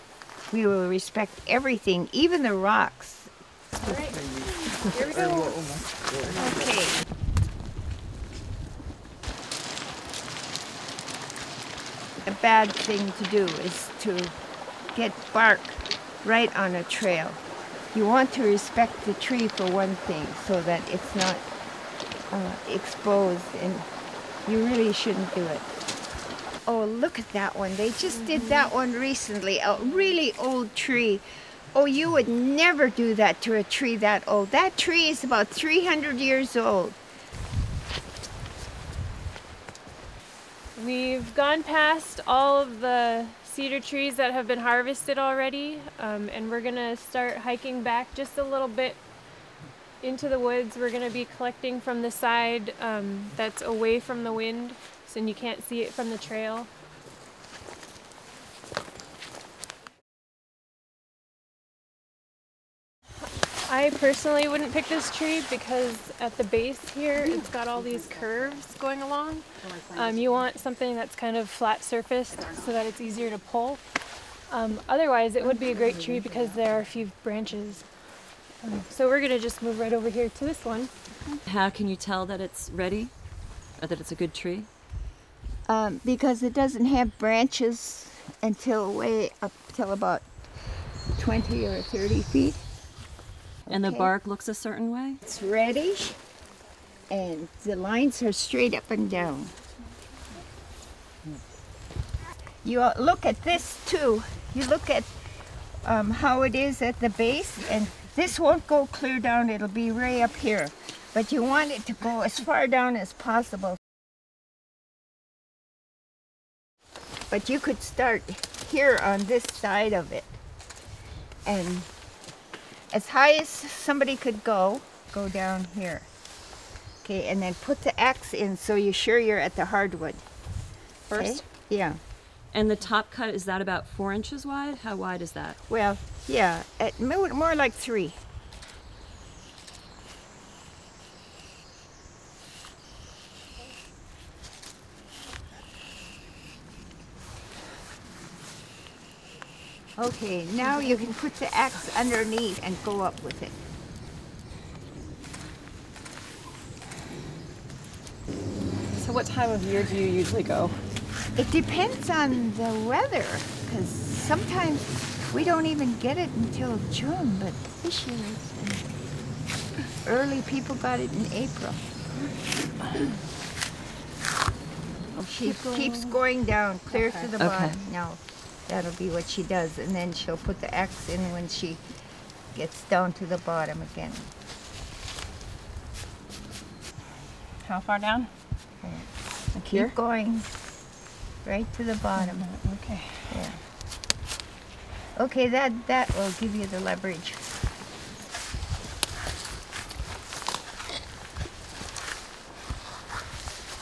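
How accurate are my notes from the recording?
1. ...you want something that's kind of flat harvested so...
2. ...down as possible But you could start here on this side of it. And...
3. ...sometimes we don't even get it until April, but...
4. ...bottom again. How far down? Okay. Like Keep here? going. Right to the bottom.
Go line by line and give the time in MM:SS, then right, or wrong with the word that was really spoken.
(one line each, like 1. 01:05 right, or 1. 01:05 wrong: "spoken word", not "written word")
1. 01:10 wrong: "surfaced", not "harvested"
2. 01:52 right
3. 02:43 wrong: "June", not "April"
4. 03:03 right.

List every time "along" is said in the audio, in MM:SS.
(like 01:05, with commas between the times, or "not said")
01:09.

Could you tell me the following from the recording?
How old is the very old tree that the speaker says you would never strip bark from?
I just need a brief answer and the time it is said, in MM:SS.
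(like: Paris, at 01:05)
300 years, at 00:35.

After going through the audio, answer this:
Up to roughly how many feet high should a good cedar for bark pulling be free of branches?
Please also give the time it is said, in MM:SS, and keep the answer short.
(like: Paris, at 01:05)
20 or 30 feet, at 01:31.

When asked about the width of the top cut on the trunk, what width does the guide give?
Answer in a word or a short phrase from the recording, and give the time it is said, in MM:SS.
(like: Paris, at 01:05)
3 inches, at 02:16.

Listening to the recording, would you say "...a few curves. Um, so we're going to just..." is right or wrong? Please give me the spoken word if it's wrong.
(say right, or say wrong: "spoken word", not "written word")
wrong: "branches", not "curves".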